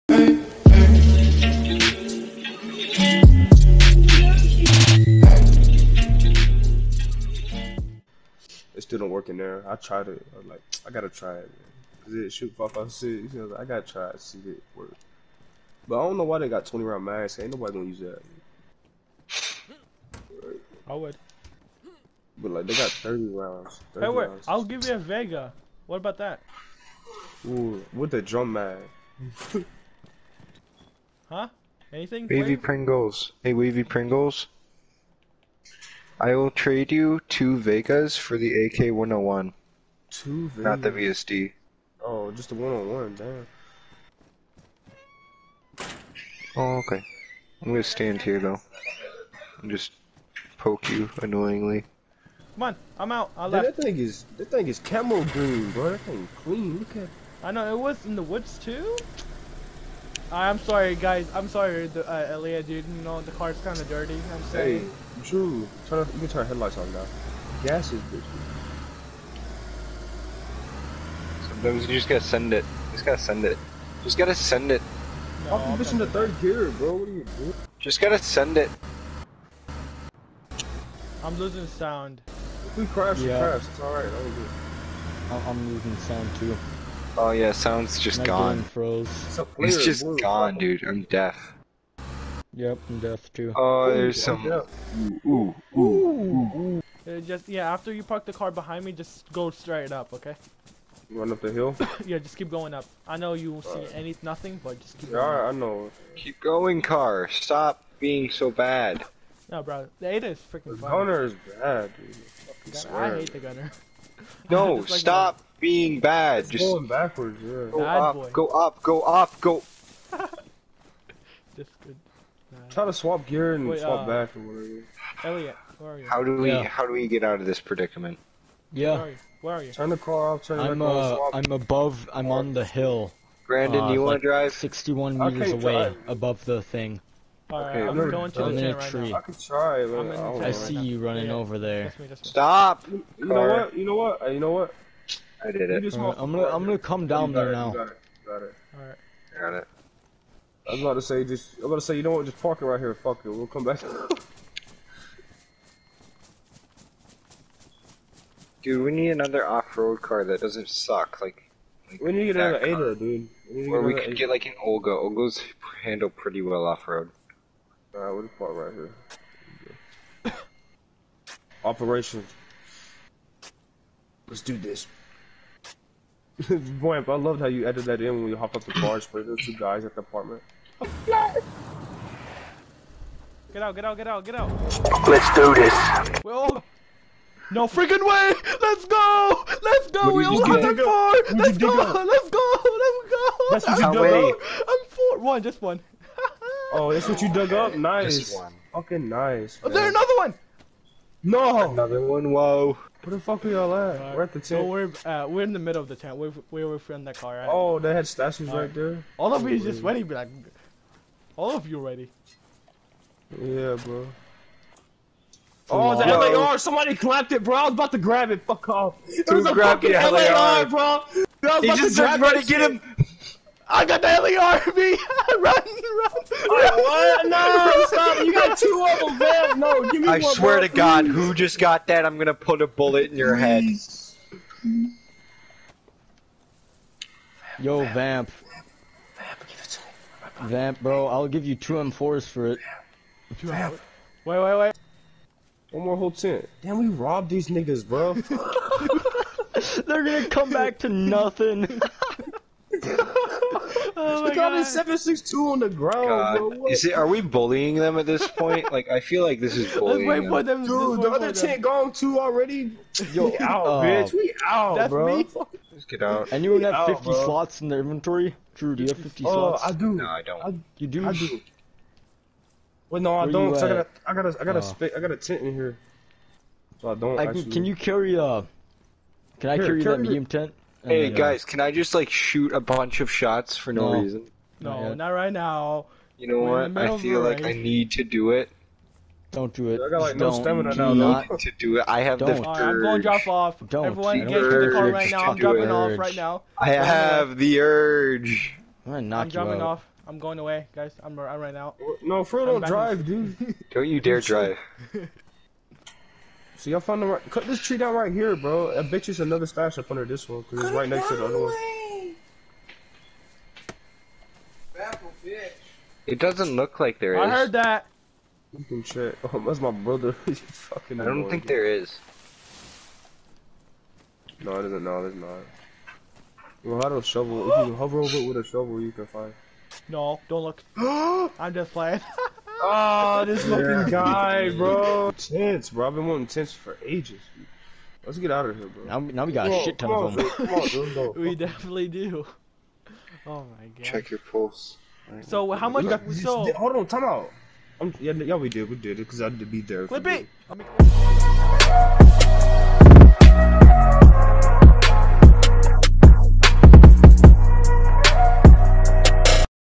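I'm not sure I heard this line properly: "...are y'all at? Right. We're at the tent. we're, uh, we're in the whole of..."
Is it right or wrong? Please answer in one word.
wrong.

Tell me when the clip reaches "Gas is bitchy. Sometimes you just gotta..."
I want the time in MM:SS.
01:07.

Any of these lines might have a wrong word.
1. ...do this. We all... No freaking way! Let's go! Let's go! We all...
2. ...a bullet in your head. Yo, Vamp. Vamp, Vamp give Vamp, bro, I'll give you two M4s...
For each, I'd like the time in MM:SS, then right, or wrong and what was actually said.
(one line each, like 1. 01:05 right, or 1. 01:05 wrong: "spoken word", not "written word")
1. 03:05 right
2. 03:52 right.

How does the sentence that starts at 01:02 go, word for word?
You know, the car's kind of dirty.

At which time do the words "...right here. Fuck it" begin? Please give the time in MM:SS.
02:32.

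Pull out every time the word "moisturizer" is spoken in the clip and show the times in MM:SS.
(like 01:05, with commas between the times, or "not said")
not said.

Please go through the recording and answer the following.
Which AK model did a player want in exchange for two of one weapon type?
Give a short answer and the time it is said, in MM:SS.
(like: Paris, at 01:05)
101, at 00:38.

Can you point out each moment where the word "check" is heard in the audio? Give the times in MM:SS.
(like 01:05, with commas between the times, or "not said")
05:18, 05:43.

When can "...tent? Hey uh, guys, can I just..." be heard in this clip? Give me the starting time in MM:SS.
04:40.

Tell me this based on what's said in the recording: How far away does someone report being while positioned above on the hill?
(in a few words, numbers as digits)
61 meters.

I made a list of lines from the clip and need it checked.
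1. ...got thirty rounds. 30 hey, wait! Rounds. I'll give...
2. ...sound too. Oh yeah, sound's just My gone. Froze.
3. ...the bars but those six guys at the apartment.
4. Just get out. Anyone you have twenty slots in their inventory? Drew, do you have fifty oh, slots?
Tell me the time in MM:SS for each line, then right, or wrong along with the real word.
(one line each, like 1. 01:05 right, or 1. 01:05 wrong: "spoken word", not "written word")
1. 00:22 right
2. 01:25 right
3. 02:58 wrong: "two", not "six"
4. 04:25 wrong: "fifty", not "twenty".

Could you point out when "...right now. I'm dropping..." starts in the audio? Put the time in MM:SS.
04:54.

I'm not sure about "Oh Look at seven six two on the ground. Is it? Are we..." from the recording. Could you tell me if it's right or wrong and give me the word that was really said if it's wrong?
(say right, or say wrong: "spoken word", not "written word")
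right.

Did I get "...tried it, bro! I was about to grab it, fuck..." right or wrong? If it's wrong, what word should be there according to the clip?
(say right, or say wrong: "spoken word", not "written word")
wrong: "clapped", not "tried".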